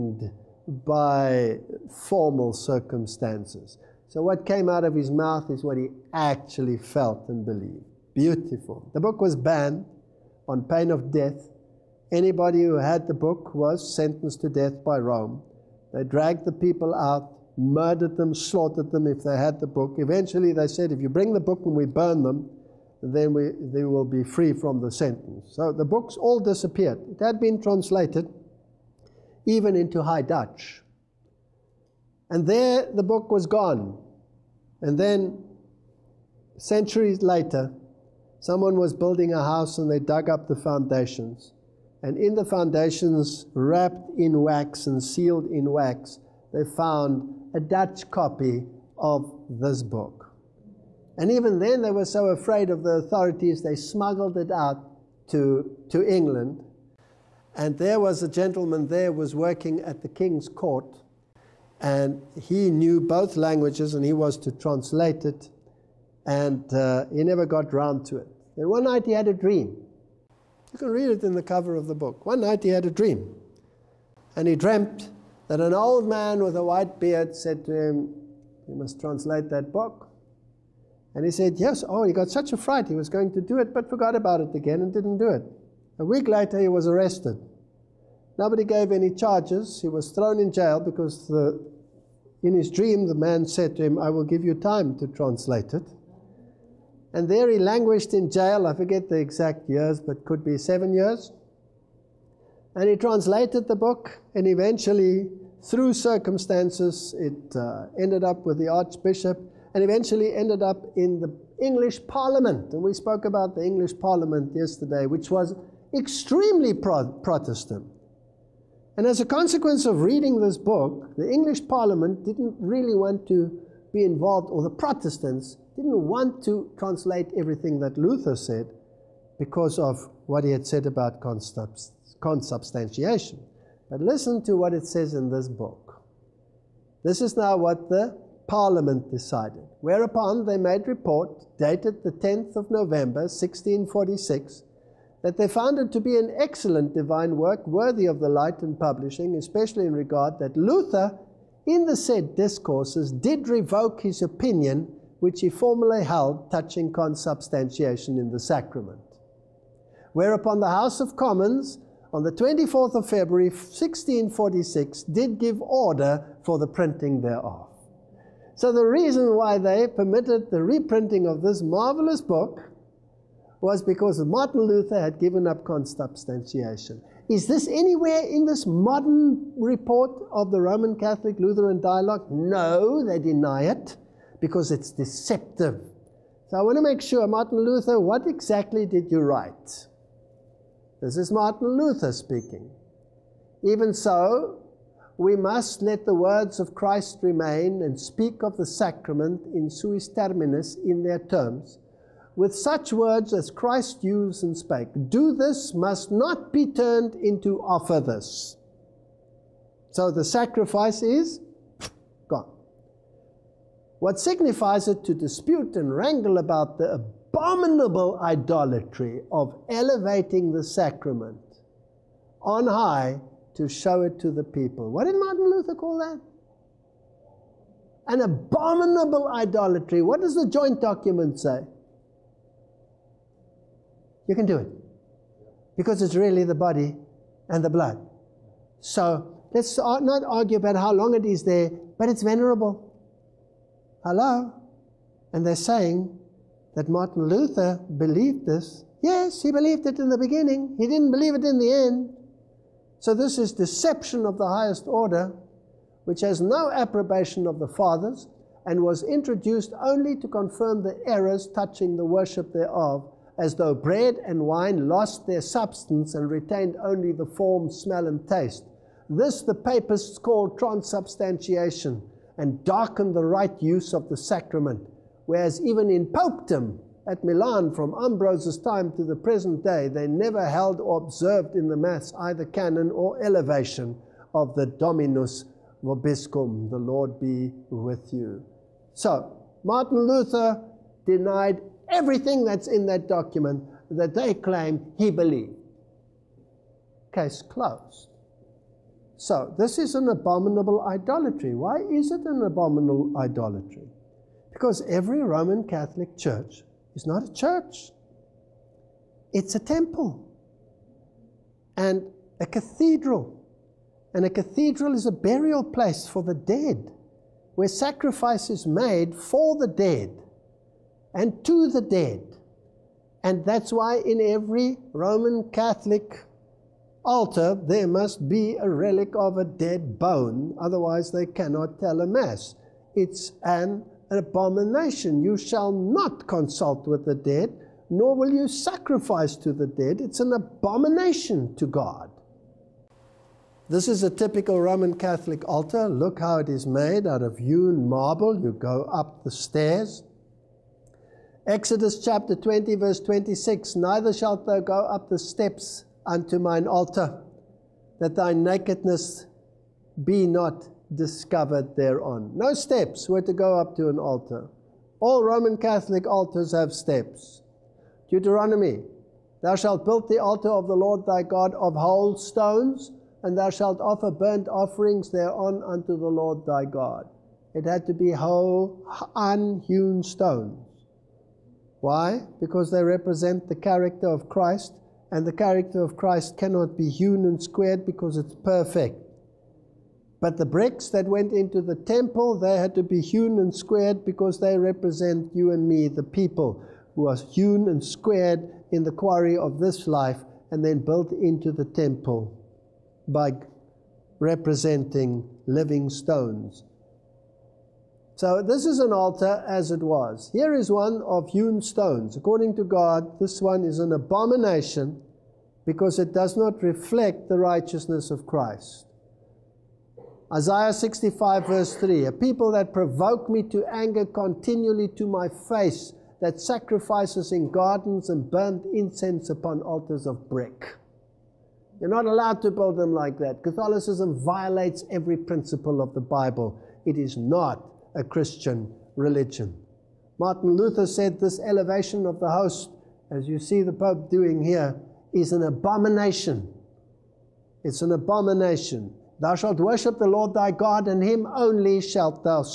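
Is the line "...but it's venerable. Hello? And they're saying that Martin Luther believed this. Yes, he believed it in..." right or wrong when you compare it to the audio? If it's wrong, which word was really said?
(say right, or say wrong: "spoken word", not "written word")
right.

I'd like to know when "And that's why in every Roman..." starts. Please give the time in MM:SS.
05:23.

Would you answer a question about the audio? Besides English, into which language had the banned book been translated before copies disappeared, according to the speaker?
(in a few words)
High Dutch.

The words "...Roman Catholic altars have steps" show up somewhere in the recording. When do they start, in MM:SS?
06:05.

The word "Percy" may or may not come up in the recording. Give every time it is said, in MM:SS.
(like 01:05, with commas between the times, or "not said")
not said.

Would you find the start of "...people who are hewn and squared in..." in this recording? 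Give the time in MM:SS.
06:36.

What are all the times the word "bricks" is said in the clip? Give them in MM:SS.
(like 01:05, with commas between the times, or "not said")
06:30, 07:10.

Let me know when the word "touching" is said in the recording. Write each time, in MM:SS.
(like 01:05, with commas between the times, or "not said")
02:36, 04:21.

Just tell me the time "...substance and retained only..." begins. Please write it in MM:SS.
04:25.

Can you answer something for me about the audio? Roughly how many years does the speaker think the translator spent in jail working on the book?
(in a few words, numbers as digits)
7.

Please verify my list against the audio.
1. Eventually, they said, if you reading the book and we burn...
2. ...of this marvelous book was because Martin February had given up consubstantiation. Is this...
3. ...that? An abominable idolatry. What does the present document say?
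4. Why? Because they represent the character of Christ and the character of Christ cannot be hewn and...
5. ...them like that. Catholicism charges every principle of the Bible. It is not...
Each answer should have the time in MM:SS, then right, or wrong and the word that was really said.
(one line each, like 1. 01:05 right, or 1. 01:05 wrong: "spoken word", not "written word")
1. 00:19 wrong: "bring", not "reading"
2. 02:51 wrong: "Luther", not "February"
3. 03:45 wrong: "joint", not "present"
4. 06:21 right
5. 07:12 wrong: "violates", not "charges".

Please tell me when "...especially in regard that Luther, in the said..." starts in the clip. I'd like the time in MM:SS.
02:29.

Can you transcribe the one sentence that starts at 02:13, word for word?
But listen to what it says in this book.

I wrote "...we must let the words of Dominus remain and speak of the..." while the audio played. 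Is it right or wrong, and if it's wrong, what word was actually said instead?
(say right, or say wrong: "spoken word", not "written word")
wrong: "Christ", not "Dominus".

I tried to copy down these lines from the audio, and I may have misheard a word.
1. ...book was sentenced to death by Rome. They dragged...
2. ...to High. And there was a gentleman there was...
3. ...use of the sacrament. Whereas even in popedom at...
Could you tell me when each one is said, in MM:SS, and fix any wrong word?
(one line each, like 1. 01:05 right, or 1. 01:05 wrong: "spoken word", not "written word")
1. 00:13 right
2. 00:55 wrong: "England", not "High"
3. 04:33 right.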